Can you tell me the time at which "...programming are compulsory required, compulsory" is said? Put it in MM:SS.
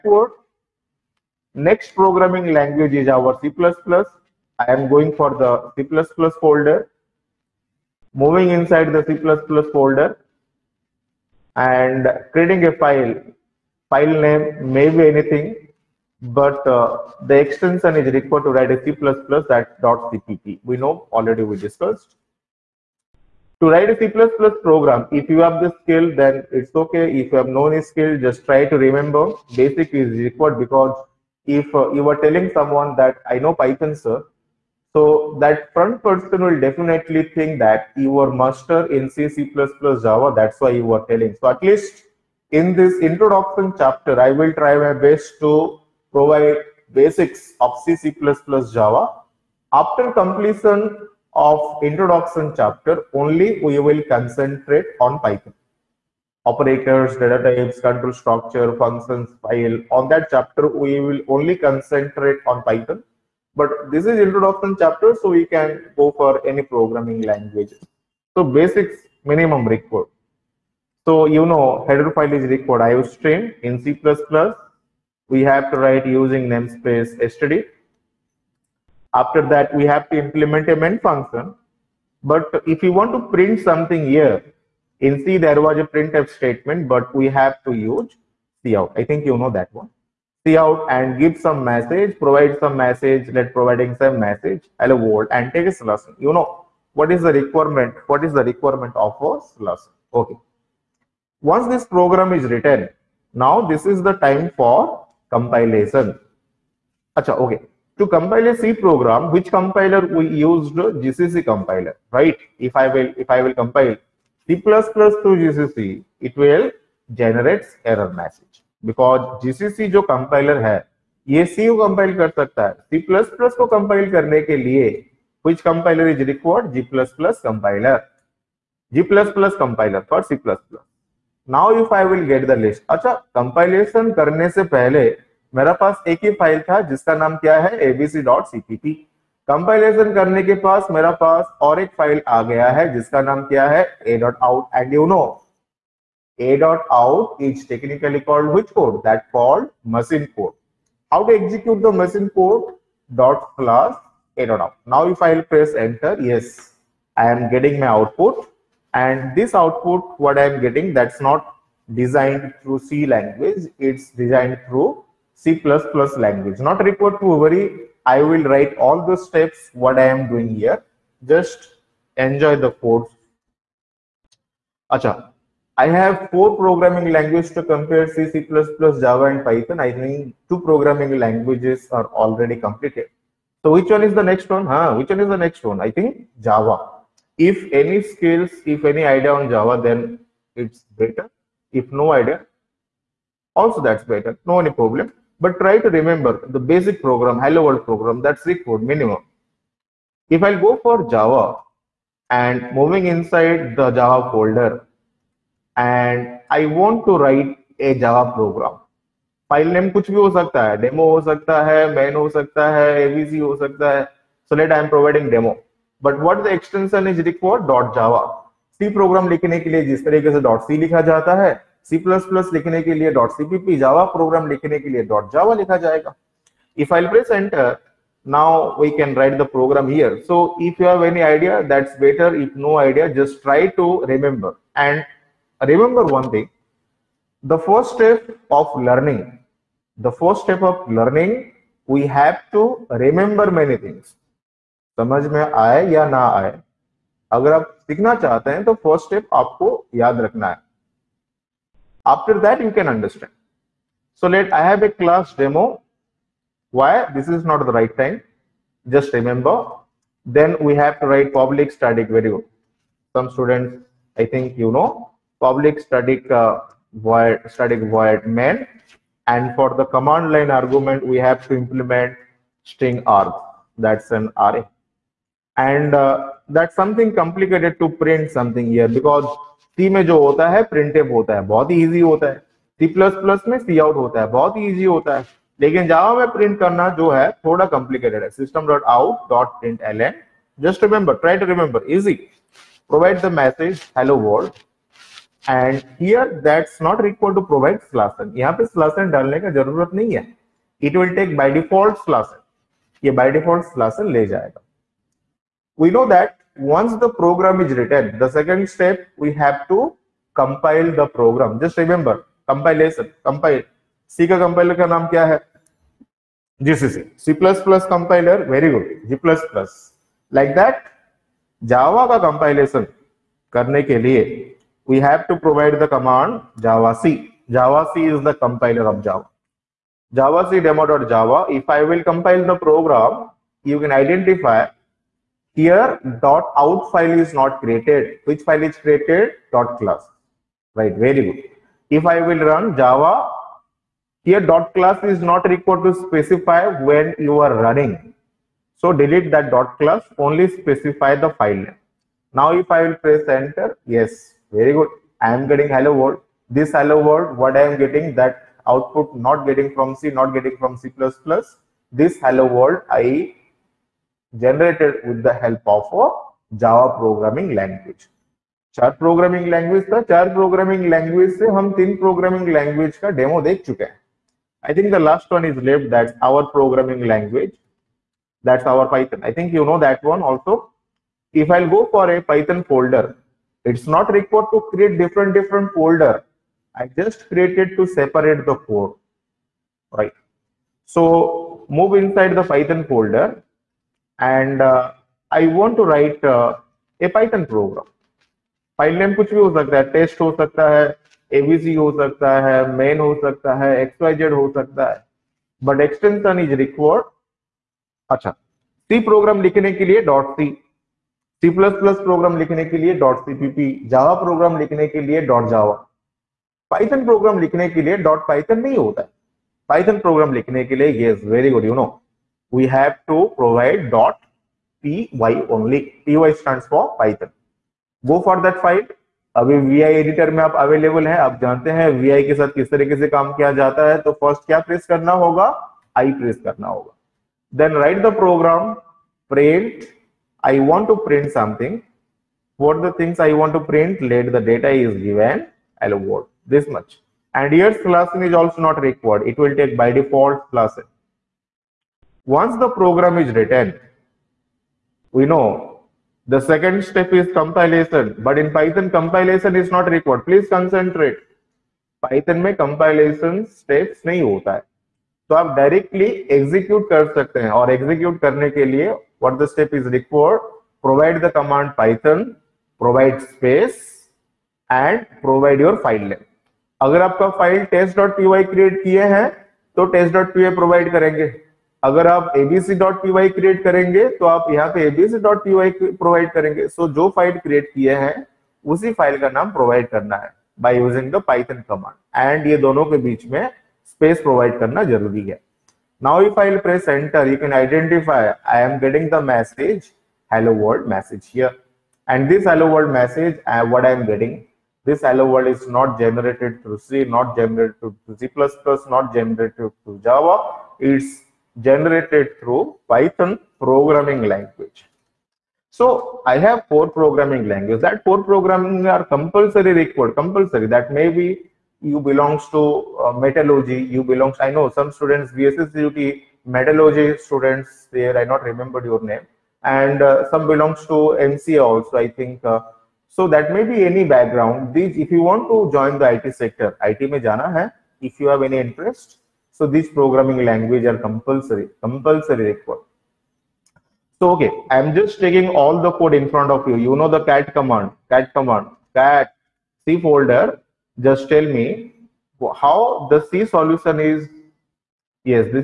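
08:38.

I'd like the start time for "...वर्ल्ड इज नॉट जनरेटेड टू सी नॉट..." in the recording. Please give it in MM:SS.
08:25.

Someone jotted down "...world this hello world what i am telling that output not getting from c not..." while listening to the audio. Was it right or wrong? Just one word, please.
wrong.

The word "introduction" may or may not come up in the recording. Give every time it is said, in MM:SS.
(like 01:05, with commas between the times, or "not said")
00:43, 00:51, 01:04.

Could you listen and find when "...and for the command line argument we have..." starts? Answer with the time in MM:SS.
04:29.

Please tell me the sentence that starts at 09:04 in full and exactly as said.
So okay, I'm just taking all the code in front of you.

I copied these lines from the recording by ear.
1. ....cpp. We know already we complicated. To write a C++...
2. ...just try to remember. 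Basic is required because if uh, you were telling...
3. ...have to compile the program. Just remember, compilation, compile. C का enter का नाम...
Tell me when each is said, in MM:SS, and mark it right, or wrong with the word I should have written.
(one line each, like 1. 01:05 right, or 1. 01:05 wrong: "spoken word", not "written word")
1. 00:19 wrong: "discussed", not "complicated"
2. 00:28 right
3. 05:09 wrong: "compiler", not "enter".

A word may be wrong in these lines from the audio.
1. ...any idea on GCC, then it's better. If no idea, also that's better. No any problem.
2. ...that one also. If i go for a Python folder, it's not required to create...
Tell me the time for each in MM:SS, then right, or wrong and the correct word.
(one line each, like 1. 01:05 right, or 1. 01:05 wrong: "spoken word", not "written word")
1. 03:08 wrong: "Java", not "GCC"
2. 06:19 right.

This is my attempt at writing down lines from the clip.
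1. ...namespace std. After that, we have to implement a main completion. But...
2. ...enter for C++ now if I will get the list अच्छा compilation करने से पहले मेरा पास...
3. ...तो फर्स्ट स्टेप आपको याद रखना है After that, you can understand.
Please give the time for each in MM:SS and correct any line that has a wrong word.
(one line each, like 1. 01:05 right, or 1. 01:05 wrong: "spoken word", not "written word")
1. 01:16 wrong: "function", not "completion"
2. 02:09 wrong: "compiler", not "enter"
3. 04:08 right.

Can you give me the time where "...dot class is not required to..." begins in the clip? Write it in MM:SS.
05:44.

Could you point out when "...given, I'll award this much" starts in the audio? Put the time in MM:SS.
07:25.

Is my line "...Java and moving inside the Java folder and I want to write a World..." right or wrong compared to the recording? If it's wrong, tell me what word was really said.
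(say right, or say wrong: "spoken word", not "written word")
wrong: "Java", not "World".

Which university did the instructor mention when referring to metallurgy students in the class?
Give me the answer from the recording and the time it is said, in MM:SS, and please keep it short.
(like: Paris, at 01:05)
VSSUT, at 08:45.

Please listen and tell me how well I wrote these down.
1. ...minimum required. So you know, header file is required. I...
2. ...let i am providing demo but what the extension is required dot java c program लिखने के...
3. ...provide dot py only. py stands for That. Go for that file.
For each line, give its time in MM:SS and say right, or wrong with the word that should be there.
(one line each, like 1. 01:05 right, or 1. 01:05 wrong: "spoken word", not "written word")
1. 01:09 right
2. 03:34 right
3. 07:03 wrong: "Python", not "That".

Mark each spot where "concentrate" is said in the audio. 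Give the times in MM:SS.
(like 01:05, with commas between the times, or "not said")
00:54, 01:01, 07:40.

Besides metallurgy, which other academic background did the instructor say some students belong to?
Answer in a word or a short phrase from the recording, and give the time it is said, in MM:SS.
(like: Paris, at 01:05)
MCA, at 08:51.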